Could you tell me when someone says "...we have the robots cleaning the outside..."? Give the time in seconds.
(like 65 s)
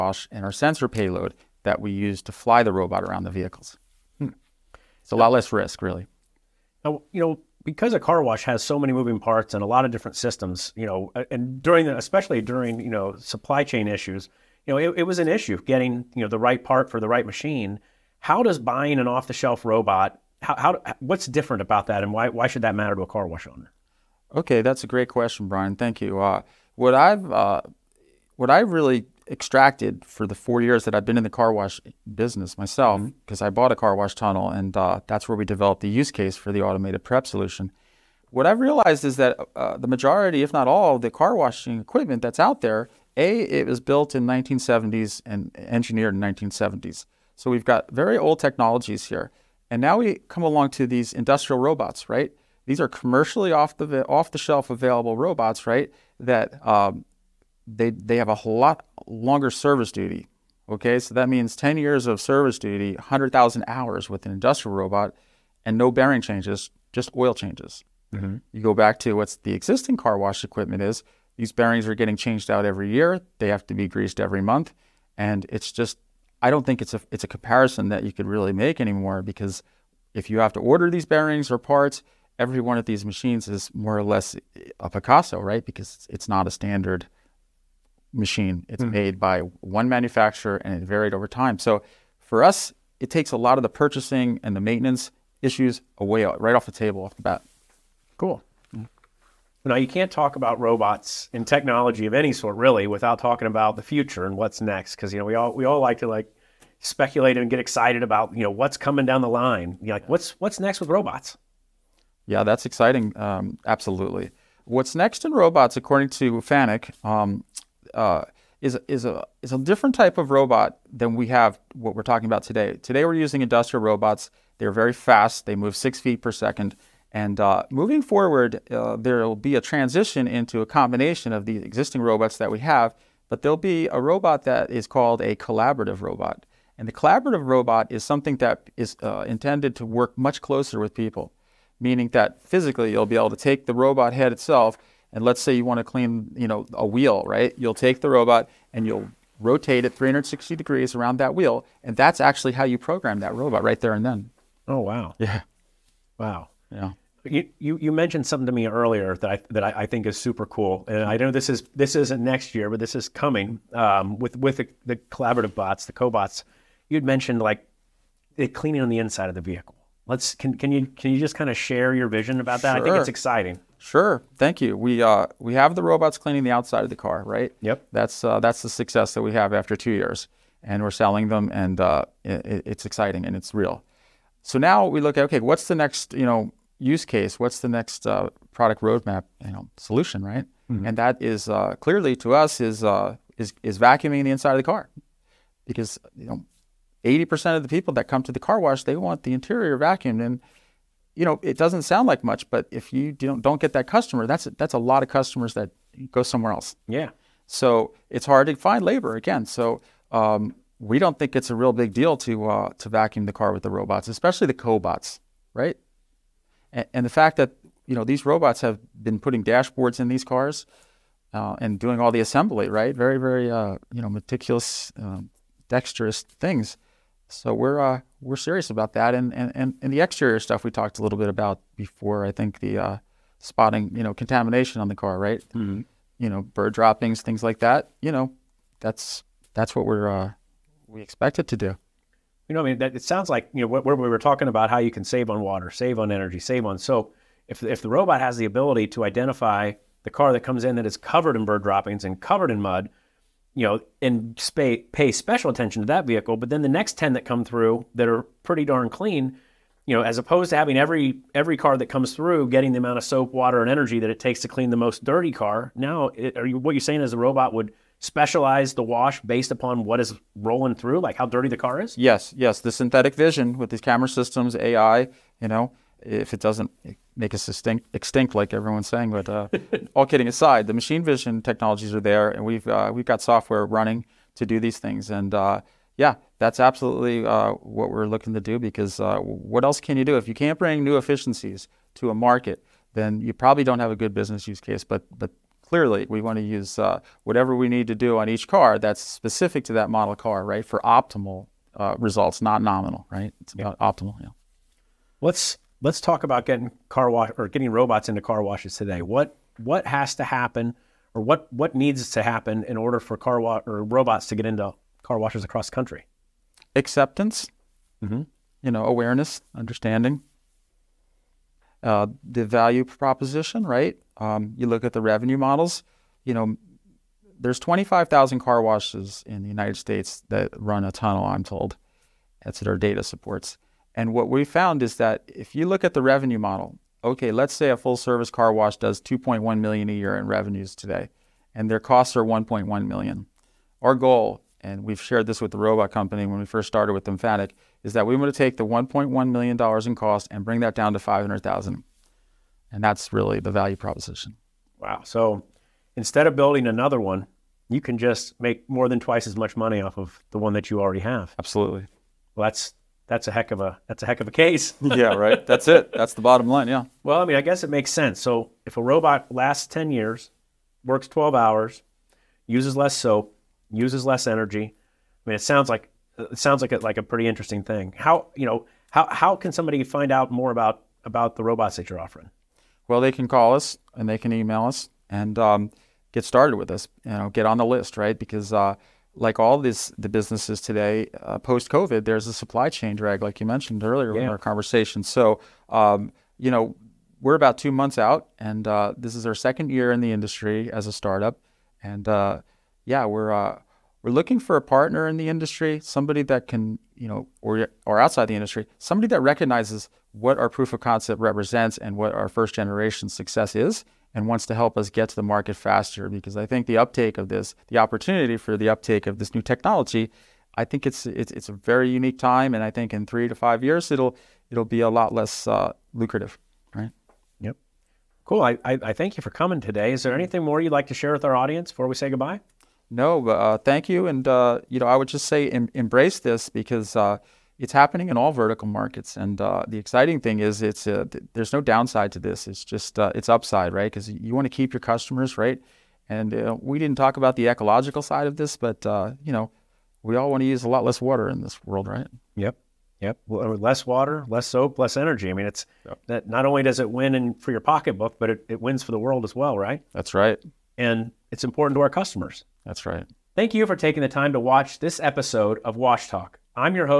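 175 s.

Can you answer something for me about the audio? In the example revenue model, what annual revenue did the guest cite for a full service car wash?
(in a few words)
2.1 million.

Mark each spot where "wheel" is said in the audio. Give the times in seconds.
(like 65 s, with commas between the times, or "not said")
146 s, 151 s.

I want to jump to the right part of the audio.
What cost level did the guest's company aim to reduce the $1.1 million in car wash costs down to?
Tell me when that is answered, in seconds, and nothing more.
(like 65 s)
350 s.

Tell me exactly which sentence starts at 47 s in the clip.
So we've got very old technologies here.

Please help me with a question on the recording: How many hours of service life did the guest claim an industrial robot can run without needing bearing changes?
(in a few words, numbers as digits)
100,000 hours.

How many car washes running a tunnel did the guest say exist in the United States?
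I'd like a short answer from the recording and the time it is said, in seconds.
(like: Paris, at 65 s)
25,000, at 327 s.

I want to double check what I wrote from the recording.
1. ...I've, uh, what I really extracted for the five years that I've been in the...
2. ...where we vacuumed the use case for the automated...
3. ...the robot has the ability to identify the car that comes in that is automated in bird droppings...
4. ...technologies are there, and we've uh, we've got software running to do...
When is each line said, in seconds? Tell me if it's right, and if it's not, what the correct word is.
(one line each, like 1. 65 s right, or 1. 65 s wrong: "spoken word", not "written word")
1. 26 s wrong: "four", not "five"
2. 35 s wrong: "developed", not "vacuumed"
3. 247 s wrong: "covered", not "automated"
4. 281 s right.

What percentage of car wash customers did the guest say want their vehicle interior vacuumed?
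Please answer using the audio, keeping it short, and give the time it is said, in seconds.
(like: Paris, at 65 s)
80%, at 197 s.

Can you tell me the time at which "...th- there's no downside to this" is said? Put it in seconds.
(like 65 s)
441 s.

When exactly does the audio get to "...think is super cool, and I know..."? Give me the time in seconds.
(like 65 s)
159 s.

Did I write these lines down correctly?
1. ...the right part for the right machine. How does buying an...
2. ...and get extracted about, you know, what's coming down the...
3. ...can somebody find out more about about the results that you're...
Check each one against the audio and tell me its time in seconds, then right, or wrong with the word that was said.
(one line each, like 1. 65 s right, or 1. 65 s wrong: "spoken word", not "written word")
1. 16 s right
2. 107 s wrong: "excited", not "extracted"
3. 379 s wrong: "robots", not "results".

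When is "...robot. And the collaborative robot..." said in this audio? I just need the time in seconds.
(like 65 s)
136 s.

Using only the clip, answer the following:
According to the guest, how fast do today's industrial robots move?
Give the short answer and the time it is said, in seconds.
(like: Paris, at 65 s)
6 feet per second, at 125 s.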